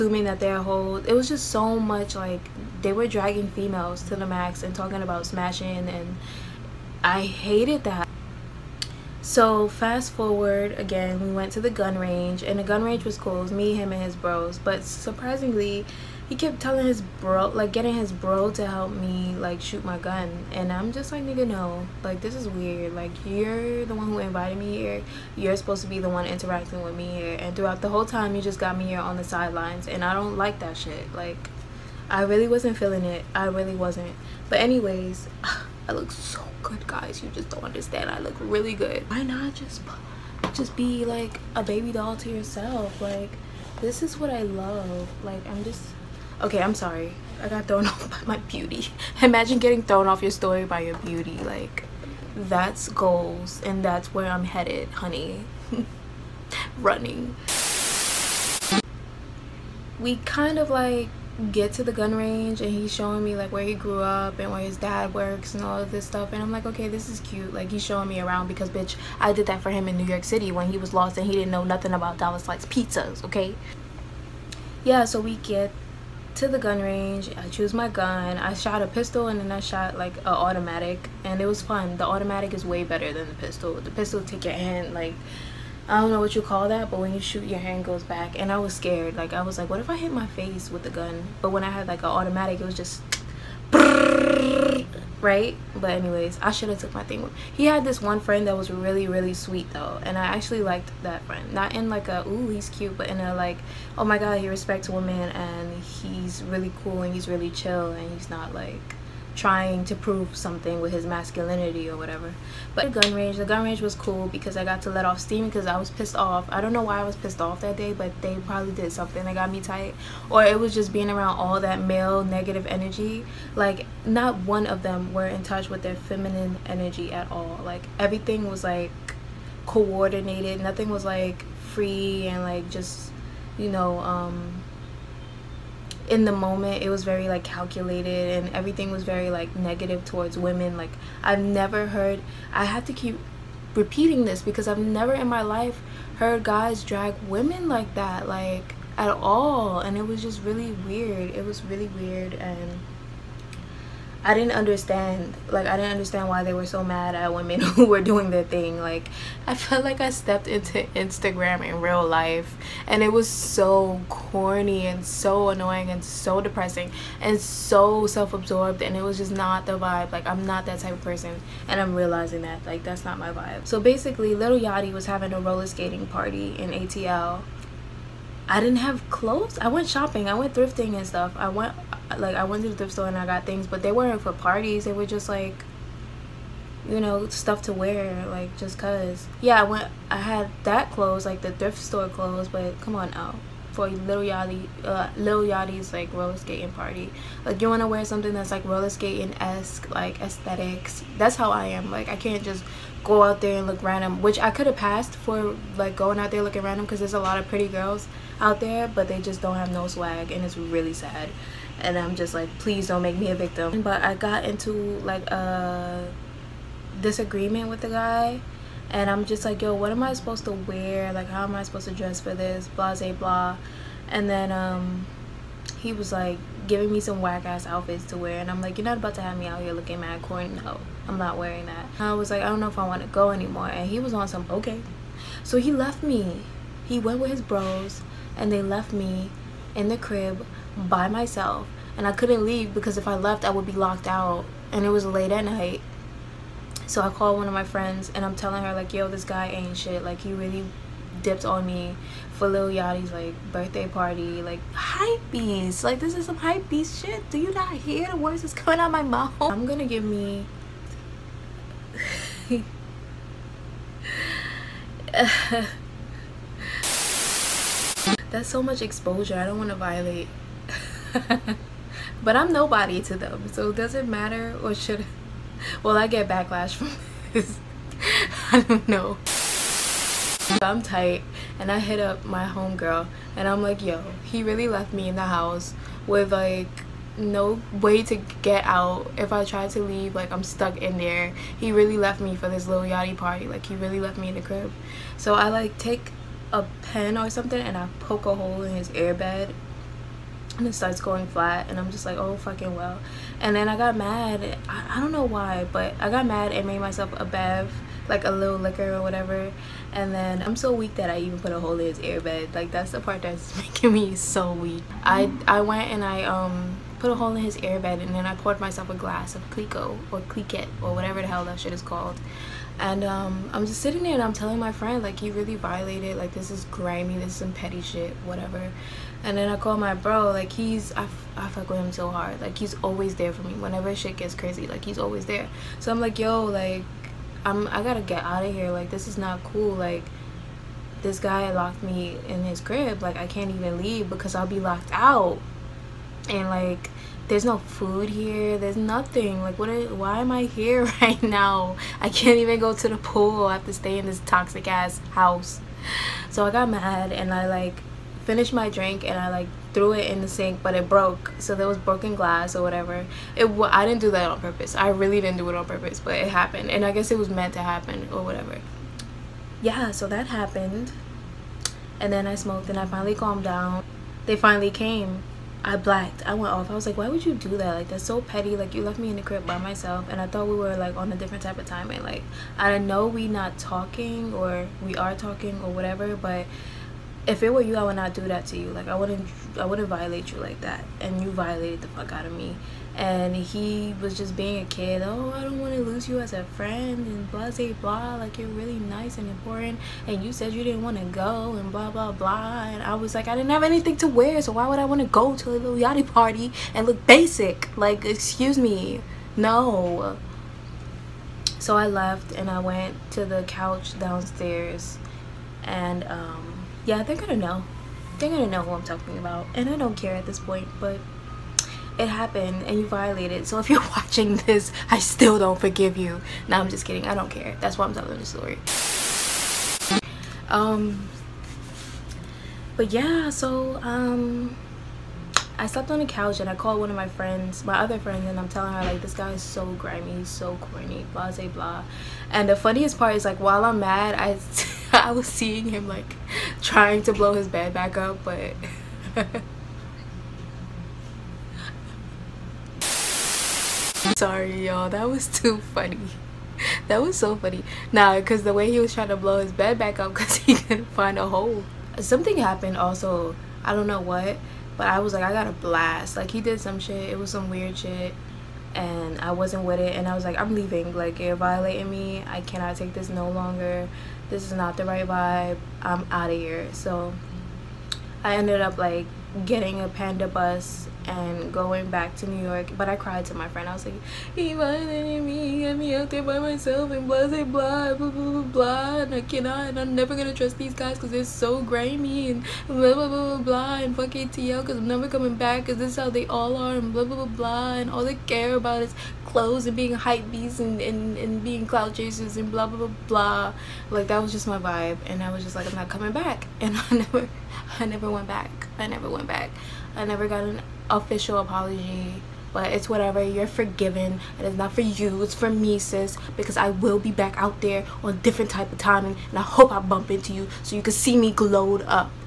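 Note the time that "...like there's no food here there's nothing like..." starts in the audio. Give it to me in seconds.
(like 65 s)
346 s.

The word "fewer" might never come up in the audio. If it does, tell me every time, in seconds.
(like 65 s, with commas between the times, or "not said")
not said.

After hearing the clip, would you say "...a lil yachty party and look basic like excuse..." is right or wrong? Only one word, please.
right.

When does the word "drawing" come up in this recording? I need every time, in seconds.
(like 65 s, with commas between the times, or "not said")
not said.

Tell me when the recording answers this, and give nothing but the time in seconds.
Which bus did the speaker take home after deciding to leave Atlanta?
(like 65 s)
479 s.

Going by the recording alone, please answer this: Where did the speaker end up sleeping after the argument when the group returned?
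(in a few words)
The couch downstairs.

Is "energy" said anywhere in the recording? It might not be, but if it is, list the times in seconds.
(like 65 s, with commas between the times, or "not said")
122 s, 126 s.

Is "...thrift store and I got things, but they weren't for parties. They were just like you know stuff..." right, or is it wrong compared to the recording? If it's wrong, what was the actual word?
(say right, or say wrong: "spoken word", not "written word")
right.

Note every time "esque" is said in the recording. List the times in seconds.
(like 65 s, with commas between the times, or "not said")
199 s.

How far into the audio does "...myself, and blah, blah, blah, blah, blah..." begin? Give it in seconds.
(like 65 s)
486 s.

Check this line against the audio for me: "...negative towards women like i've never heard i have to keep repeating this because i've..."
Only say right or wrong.
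right.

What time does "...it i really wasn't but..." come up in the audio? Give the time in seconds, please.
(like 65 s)
33 s.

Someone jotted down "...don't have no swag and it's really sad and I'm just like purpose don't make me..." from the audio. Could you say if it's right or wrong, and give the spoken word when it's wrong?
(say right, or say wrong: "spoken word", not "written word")
wrong: "please", not "purpose".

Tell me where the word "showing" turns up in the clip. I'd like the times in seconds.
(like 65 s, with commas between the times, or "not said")
62 s, 67 s.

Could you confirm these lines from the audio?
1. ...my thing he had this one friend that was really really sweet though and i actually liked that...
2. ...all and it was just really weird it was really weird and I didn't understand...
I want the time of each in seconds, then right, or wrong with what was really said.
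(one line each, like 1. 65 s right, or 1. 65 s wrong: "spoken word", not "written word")
1. 96 s right
2. 149 s right.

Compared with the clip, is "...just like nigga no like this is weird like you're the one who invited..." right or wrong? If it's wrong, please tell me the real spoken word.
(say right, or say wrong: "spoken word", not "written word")
right.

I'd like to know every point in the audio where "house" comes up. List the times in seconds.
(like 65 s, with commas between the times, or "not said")
285 s, 355 s.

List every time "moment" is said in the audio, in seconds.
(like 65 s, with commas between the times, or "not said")
136 s.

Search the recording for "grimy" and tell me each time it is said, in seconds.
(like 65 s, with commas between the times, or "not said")
326 s, 439 s, 491 s.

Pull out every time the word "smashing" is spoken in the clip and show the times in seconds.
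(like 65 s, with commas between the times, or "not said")
5 s.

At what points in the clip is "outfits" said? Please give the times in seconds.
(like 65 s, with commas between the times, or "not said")
227 s.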